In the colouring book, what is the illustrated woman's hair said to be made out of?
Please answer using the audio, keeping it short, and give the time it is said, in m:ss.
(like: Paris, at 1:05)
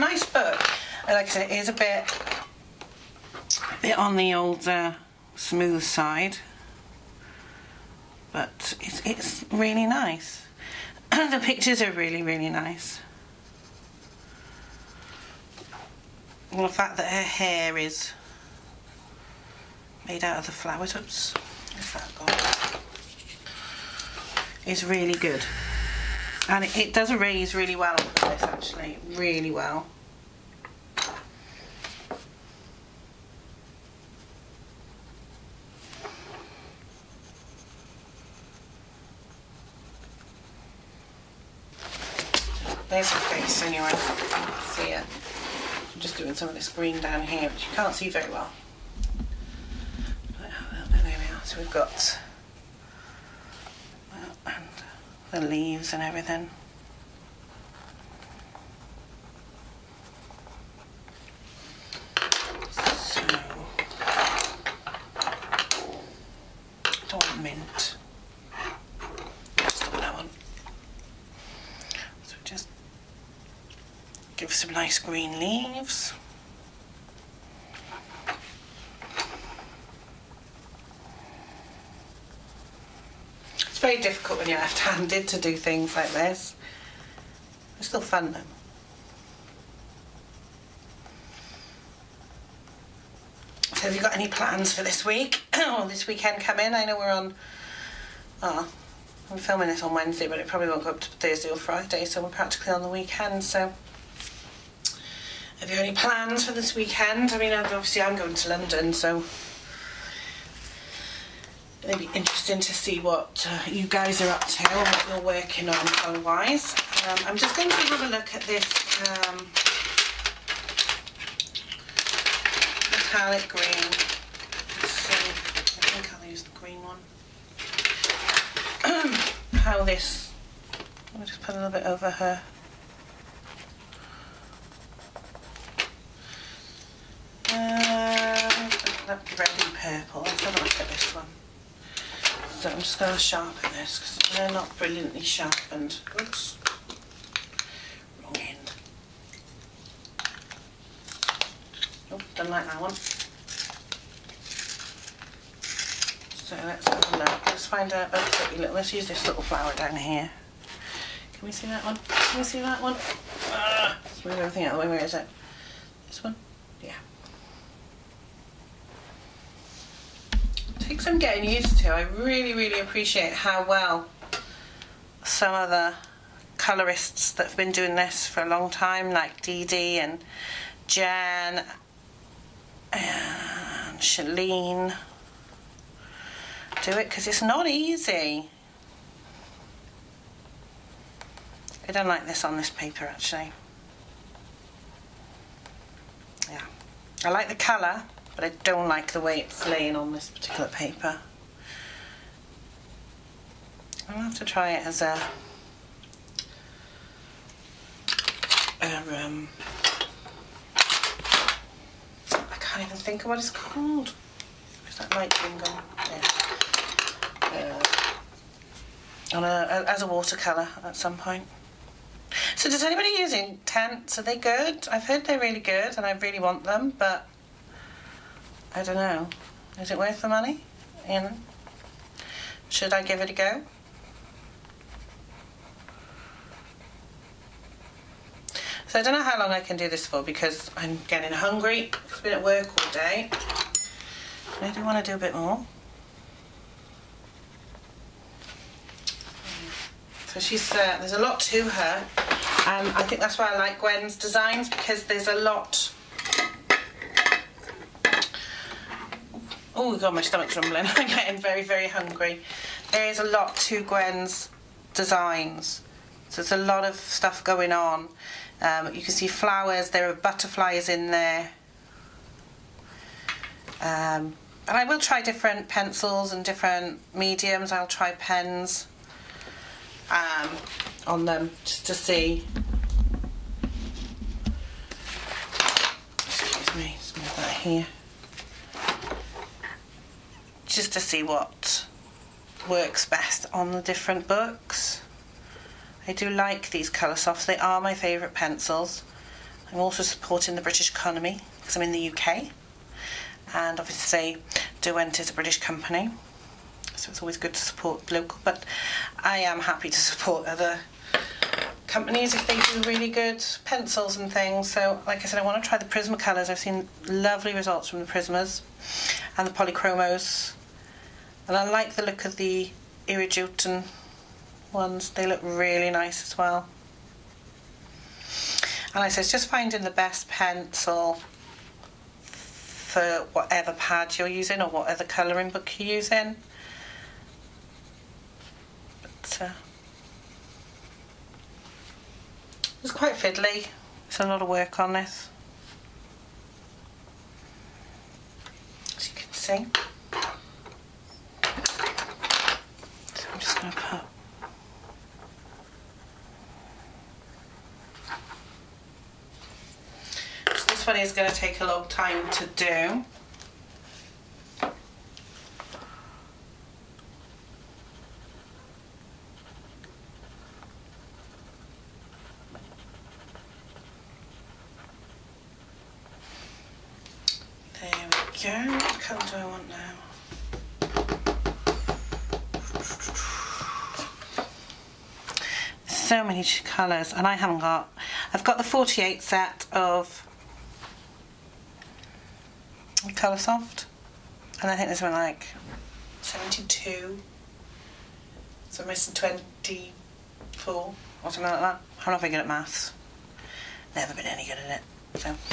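The flower, at 0:20.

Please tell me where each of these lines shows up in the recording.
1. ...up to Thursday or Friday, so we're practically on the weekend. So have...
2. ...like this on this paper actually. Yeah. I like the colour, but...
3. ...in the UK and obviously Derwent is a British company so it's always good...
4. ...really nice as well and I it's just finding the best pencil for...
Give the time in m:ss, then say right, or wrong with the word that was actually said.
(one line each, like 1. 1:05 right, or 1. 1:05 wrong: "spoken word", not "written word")
1. 1:40 right
2. 3:12 right
3. 5:01 right
4. 5:25 right.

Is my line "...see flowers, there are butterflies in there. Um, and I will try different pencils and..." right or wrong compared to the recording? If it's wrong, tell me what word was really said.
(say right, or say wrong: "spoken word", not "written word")
right.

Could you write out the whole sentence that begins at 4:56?
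I do like these colour softs, they are my favourite pencils.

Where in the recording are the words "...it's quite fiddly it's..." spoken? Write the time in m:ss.
5:42.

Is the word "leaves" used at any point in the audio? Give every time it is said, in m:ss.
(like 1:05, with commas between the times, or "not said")
0:55, 1:15.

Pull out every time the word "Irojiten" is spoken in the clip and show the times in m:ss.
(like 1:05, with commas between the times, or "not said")
5:23.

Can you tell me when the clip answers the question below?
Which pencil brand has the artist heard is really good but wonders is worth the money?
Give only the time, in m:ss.
3:43.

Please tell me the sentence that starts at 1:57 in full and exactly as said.
Um, I'm just going to have a look at this um, metallic green.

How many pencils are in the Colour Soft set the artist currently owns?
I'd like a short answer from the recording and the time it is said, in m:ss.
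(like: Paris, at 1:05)
48, at 6:28.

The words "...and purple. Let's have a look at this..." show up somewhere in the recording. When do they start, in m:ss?
2:19.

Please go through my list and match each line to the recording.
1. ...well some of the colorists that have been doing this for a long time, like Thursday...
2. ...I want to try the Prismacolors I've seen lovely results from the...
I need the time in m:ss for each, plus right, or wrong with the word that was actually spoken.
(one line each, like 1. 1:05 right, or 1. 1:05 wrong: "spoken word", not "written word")
1. 2:53 wrong: "Dee", not "Thursday"
2. 5:15 right.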